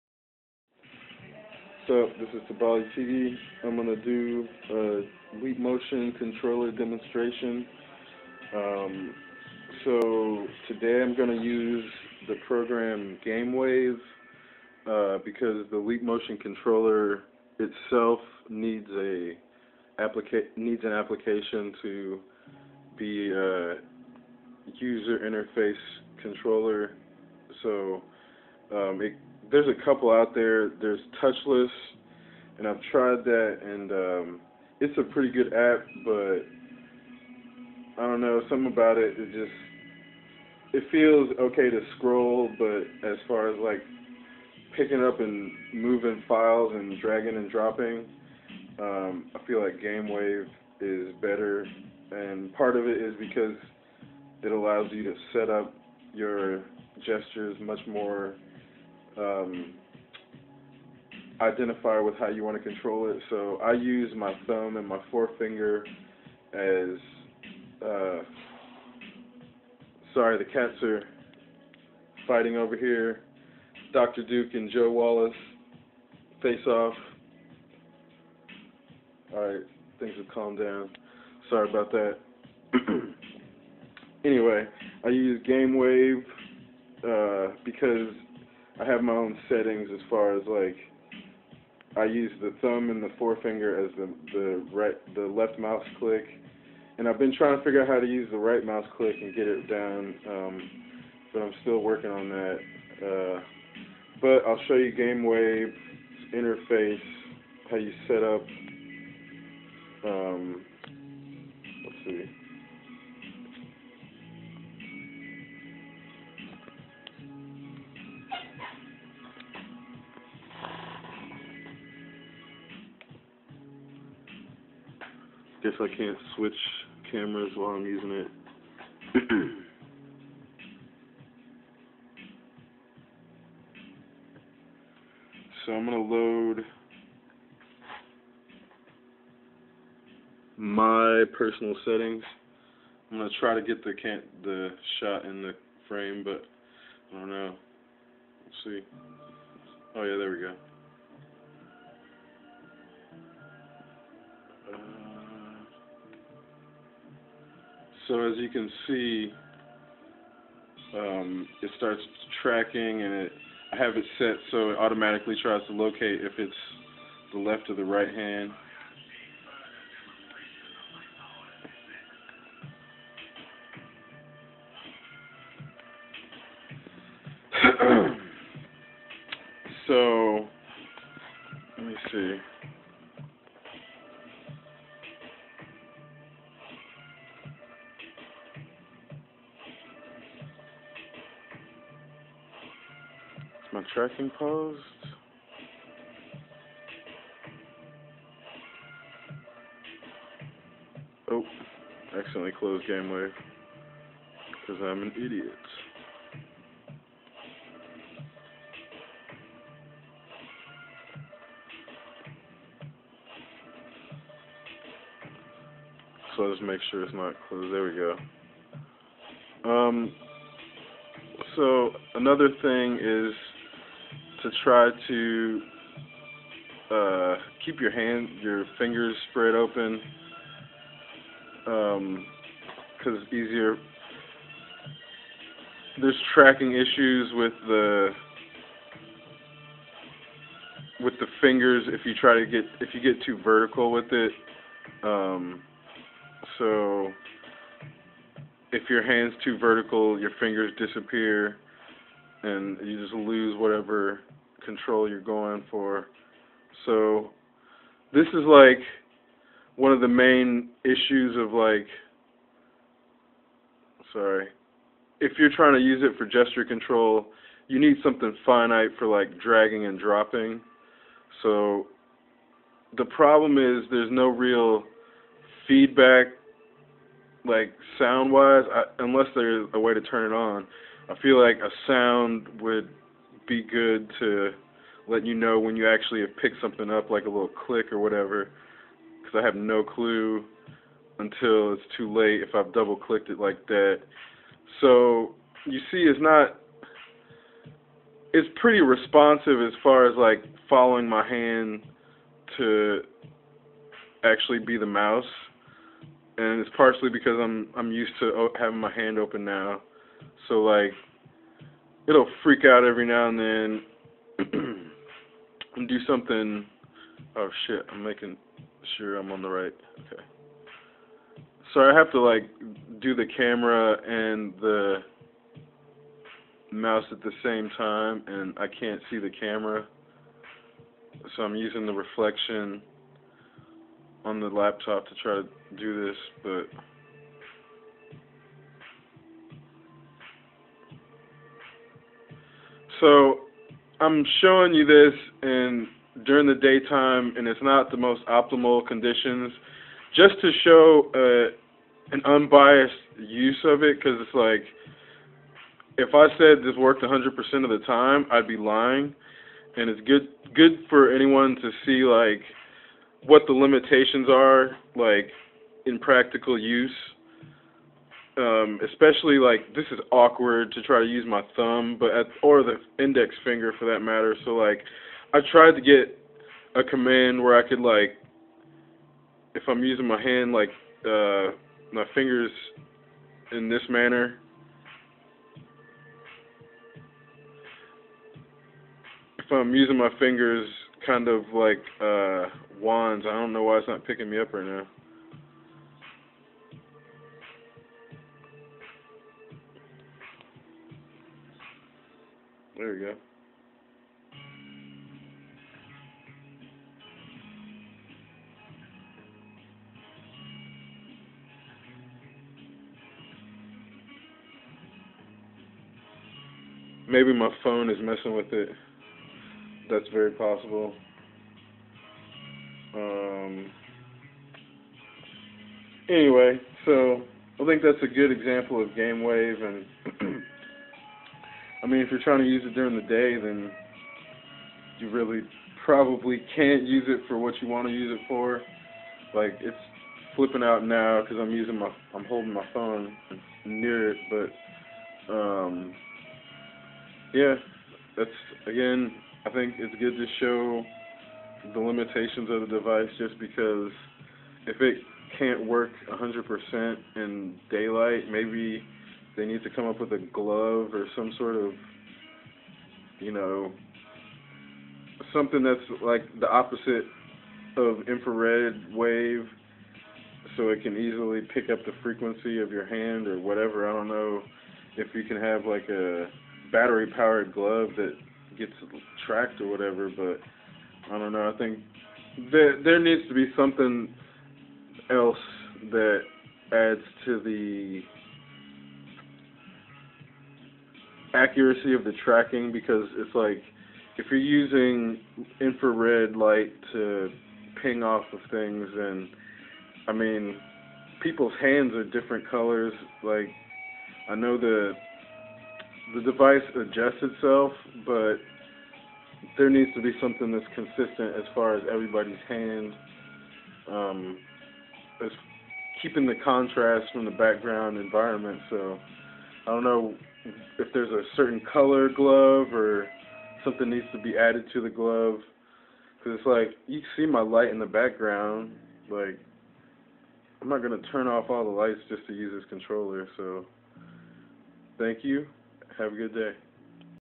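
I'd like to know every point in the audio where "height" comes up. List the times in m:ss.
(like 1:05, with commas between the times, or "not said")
not said.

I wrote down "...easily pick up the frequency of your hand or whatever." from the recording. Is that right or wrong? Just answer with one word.
right.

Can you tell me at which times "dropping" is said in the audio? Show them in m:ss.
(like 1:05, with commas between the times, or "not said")
0:47, 4:29.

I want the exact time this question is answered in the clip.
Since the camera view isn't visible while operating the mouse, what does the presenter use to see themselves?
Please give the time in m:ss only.
5:31.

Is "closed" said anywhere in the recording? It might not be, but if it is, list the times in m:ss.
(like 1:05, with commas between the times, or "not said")
3:22, 3:37.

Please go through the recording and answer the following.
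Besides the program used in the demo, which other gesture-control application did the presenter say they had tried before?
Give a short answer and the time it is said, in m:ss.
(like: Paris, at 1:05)
Touchless, at 0:31.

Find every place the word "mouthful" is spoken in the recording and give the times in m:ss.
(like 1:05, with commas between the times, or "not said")
not said.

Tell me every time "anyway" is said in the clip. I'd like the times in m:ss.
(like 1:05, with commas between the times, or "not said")
1:24, 7:06.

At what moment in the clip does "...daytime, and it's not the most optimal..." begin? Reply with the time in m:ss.
5:46.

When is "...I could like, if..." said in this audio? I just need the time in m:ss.
6:17.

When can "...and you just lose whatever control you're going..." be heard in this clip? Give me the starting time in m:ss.
4:12.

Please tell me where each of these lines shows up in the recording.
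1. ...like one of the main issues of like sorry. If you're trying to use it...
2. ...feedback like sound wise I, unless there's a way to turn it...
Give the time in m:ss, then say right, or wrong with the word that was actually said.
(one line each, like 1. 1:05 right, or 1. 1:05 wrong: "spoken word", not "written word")
1. 4:18 right
2. 4:35 right.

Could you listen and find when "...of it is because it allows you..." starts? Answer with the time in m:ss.
0:52.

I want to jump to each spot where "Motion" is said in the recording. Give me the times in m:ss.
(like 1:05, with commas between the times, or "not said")
0:05, 0:16.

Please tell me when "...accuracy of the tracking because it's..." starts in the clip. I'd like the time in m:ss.
8:11.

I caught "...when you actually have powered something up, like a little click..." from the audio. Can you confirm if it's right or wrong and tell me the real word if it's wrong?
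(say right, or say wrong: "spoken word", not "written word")
wrong: "picked", not "powered".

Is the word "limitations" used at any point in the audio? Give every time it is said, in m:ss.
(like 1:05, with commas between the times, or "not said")
6:03, 7:31.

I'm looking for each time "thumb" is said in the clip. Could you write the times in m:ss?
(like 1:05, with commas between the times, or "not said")
1:04, 1:32, 6:11.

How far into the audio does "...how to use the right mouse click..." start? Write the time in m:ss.
1:37.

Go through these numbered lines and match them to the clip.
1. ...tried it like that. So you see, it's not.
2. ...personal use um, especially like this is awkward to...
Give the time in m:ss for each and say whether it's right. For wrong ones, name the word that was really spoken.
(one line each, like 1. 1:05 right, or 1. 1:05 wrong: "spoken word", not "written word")
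1. 4:52 wrong: "clicked", not "tried"
2. 6:05 wrong: "practical", not "personal".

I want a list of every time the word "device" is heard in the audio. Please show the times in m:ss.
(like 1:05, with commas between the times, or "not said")
7:32, 8:26.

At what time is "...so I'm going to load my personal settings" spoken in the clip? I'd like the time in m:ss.
2:15.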